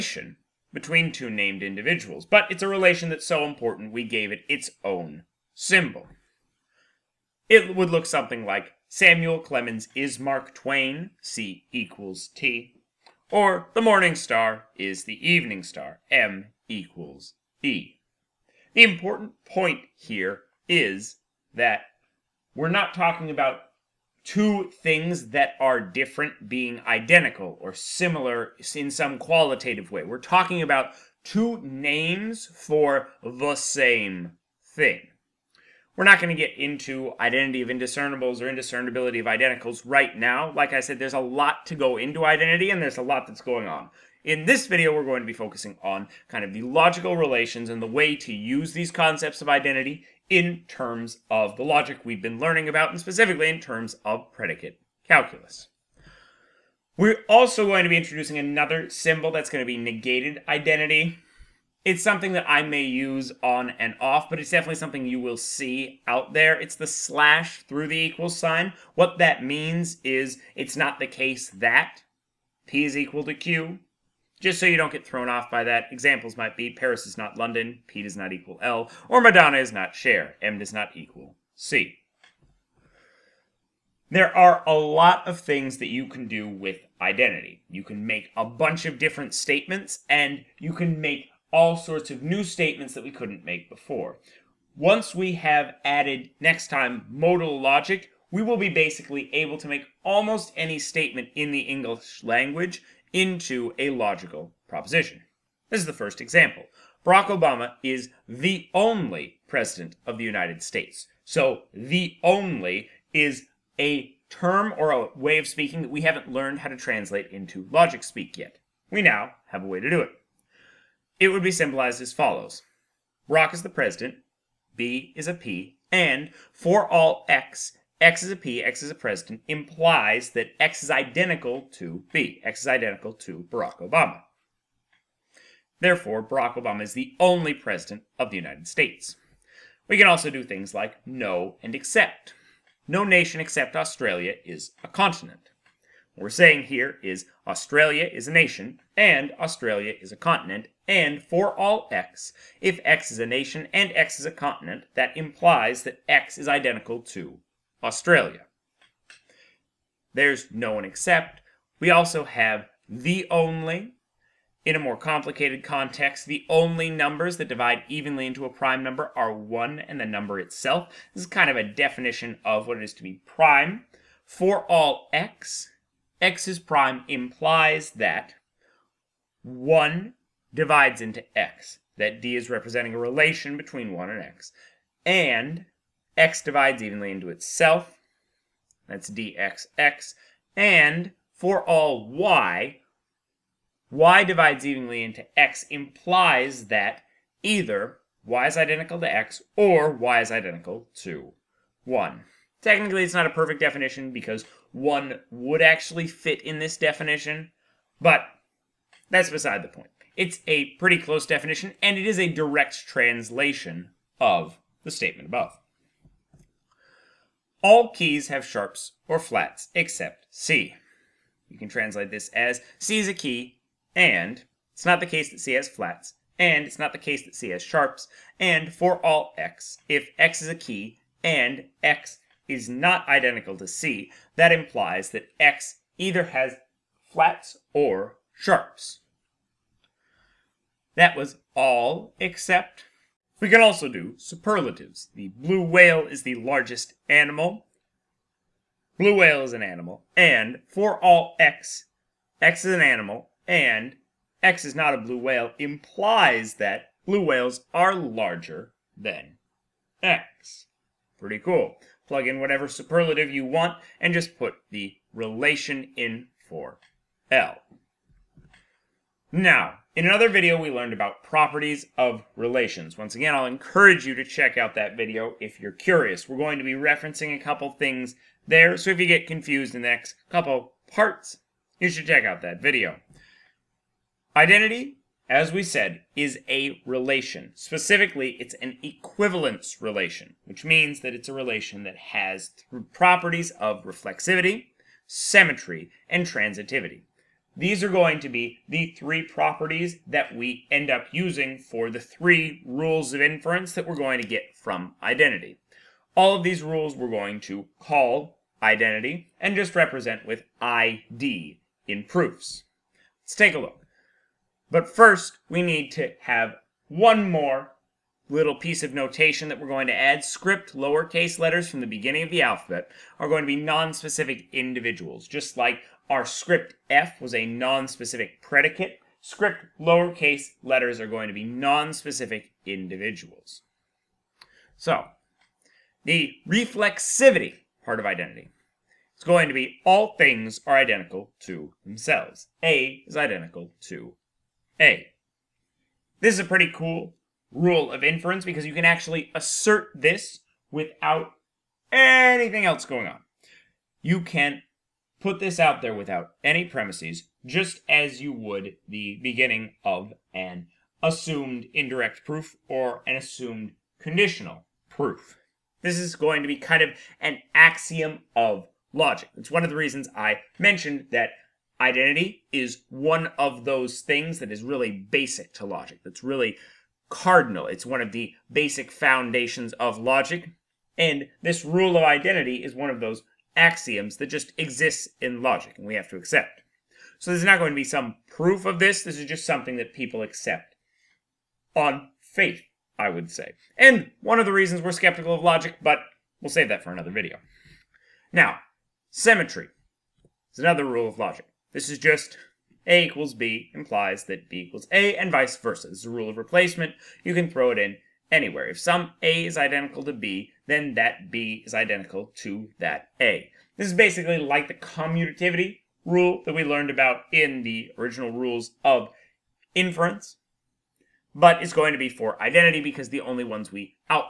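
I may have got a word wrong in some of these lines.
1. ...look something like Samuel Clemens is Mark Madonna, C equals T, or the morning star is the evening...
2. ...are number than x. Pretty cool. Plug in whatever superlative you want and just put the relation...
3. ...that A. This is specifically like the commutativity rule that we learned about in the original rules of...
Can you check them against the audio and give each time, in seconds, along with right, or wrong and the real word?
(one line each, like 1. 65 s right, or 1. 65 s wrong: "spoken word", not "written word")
1. 7 s wrong: "Twain", not "Madonna"
2. 257 s wrong: "larger", not "number"
3. 412 s wrong: "basically", not "specifically".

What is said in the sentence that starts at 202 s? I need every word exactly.
Technically, it's not a perfect definition because 1 would actually fit in this definition, but that's beside the point.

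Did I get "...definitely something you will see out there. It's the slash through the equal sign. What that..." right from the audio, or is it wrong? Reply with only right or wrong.
right.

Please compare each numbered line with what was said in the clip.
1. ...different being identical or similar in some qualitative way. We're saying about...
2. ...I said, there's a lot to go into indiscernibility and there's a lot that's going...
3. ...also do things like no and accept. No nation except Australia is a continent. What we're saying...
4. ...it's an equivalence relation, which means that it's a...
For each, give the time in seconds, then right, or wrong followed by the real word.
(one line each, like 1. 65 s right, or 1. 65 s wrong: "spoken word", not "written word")
1. 25 s wrong: "talking", not "saying"
2. 40 s wrong: "identity", not "indiscernibility"
3. 140 s right
4. 288 s right.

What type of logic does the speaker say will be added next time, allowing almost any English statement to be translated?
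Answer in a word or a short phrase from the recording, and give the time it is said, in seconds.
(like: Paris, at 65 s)
modal logic, at 97 s.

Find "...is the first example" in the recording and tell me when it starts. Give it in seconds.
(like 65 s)
105 s.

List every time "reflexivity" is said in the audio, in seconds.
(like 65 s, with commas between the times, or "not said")
293 s, 336 s.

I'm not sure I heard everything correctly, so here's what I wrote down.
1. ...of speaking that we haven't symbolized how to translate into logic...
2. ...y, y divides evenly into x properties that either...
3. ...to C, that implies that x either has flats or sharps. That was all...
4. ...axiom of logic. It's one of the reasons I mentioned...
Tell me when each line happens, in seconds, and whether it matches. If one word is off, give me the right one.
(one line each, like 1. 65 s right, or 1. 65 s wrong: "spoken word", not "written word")
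1. 115 s wrong: "learned", not "symbolized"
2. 192 s wrong: "implies", not "properties"
3. 233 s right
4. 367 s right.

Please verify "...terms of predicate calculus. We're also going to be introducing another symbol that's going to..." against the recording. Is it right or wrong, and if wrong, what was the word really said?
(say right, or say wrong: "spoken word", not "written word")
right.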